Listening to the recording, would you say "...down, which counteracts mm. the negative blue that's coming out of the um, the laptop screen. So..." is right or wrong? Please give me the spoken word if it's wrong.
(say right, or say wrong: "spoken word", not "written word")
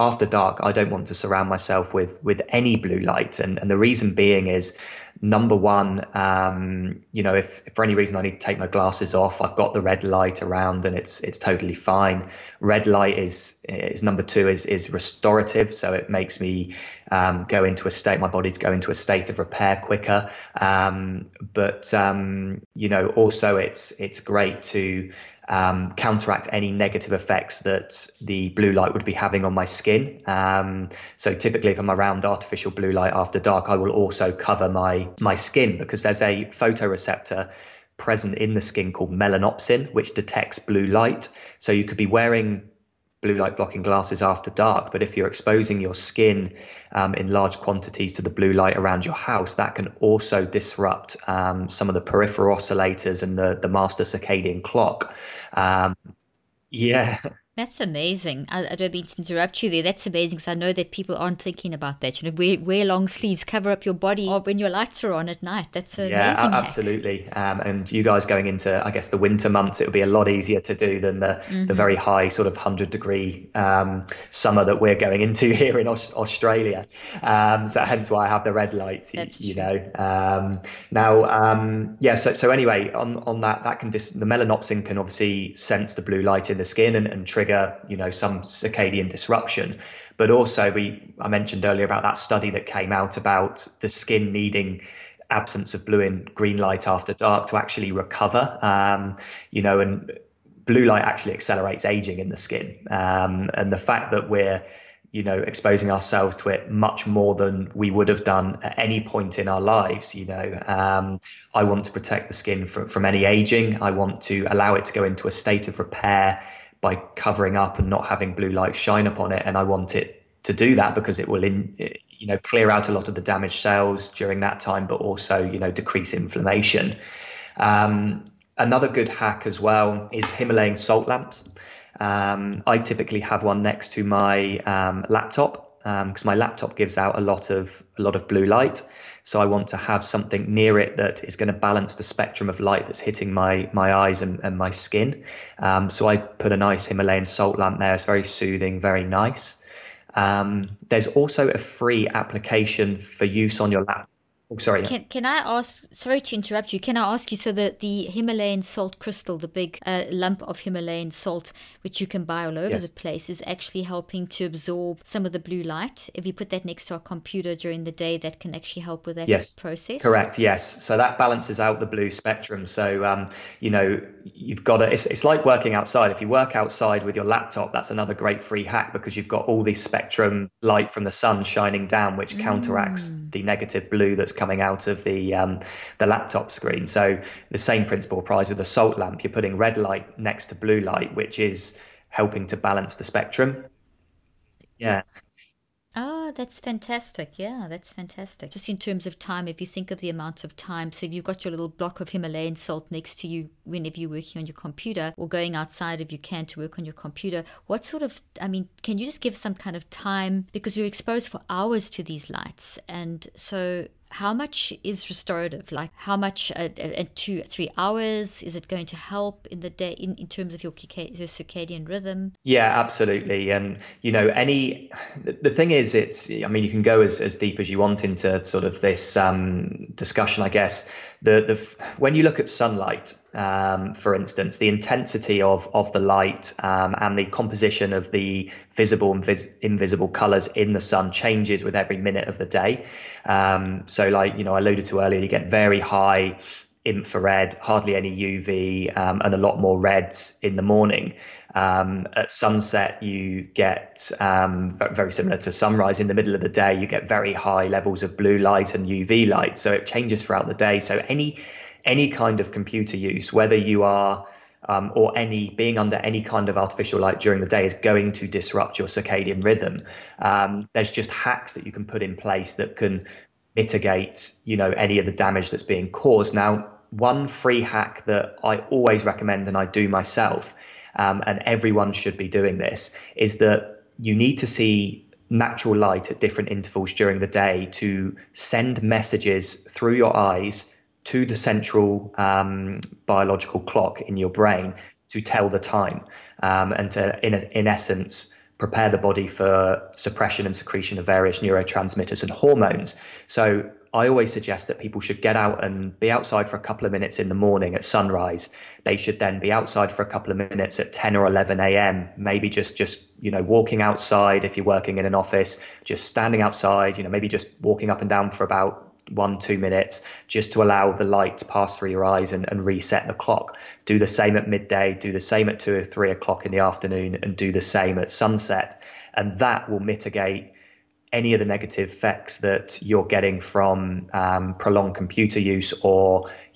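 right.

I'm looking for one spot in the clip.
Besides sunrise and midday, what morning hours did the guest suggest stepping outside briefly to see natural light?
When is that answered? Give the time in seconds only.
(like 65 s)
310 s.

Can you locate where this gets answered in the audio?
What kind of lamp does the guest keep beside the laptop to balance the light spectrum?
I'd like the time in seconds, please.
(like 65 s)
130 s.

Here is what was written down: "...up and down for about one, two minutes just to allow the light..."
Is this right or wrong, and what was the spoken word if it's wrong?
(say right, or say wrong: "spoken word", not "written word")
right.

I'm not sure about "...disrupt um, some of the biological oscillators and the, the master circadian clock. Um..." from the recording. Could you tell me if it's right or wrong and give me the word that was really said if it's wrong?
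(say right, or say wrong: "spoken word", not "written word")
wrong: "peripheral", not "biological".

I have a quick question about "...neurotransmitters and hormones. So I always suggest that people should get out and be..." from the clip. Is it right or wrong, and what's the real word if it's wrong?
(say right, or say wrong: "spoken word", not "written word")
right.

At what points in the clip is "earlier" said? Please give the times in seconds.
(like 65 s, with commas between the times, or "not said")
91 s, 245 s.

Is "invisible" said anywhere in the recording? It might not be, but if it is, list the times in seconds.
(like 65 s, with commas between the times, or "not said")
239 s.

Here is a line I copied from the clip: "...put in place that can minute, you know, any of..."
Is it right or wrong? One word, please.
wrong.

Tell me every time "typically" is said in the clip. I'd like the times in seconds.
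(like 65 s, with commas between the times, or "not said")
31 s, 132 s.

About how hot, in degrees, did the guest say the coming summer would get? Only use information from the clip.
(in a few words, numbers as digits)
100.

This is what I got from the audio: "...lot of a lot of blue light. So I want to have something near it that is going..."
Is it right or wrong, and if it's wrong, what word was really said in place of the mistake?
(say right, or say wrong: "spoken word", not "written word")
right.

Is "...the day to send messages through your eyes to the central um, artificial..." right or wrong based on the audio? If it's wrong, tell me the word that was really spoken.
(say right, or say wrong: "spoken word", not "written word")
wrong: "biological", not "artificial".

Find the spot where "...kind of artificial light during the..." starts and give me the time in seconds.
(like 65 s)
266 s.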